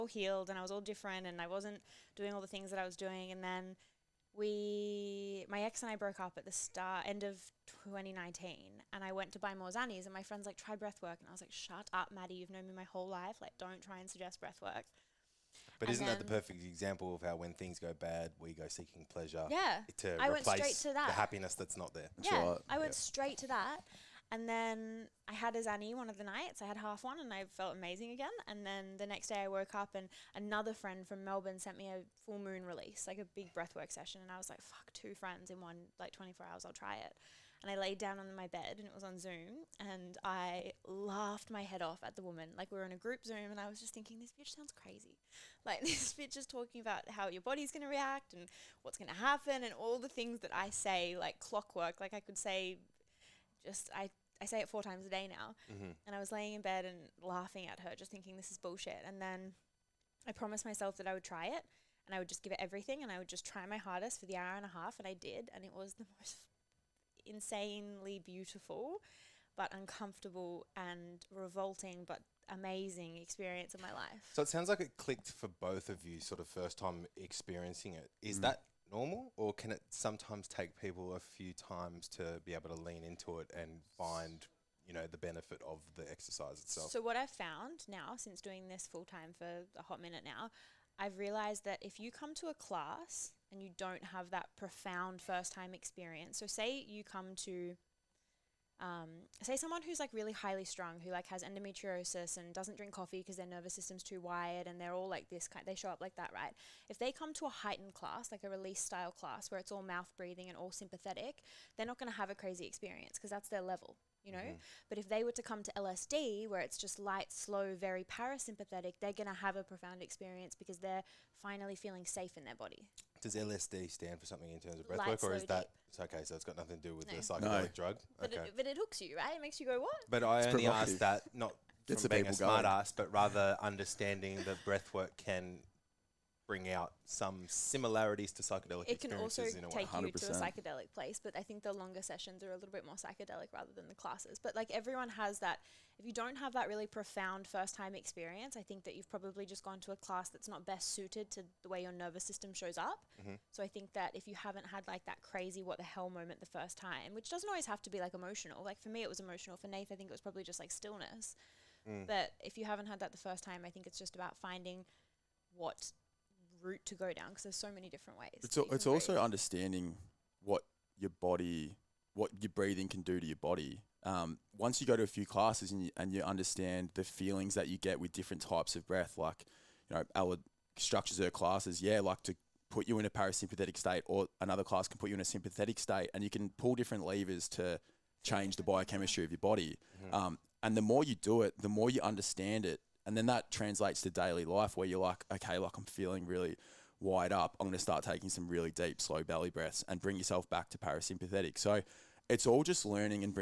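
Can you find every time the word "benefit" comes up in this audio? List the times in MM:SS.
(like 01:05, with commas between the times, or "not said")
01:25.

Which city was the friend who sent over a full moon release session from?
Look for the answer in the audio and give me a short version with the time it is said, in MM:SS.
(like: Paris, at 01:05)
Melbourne, at 00:31.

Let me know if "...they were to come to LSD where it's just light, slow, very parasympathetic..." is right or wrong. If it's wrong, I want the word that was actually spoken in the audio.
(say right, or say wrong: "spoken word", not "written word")
right.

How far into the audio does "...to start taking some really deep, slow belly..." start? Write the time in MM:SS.
03:17.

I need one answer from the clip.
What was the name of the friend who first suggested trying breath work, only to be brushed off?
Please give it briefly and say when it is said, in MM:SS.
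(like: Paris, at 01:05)
Maddie, at 00:12.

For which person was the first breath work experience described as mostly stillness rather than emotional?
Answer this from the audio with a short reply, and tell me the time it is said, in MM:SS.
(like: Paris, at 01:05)
Nate, at 02:39.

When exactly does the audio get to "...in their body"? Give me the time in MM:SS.
02:02.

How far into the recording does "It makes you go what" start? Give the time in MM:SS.
02:09.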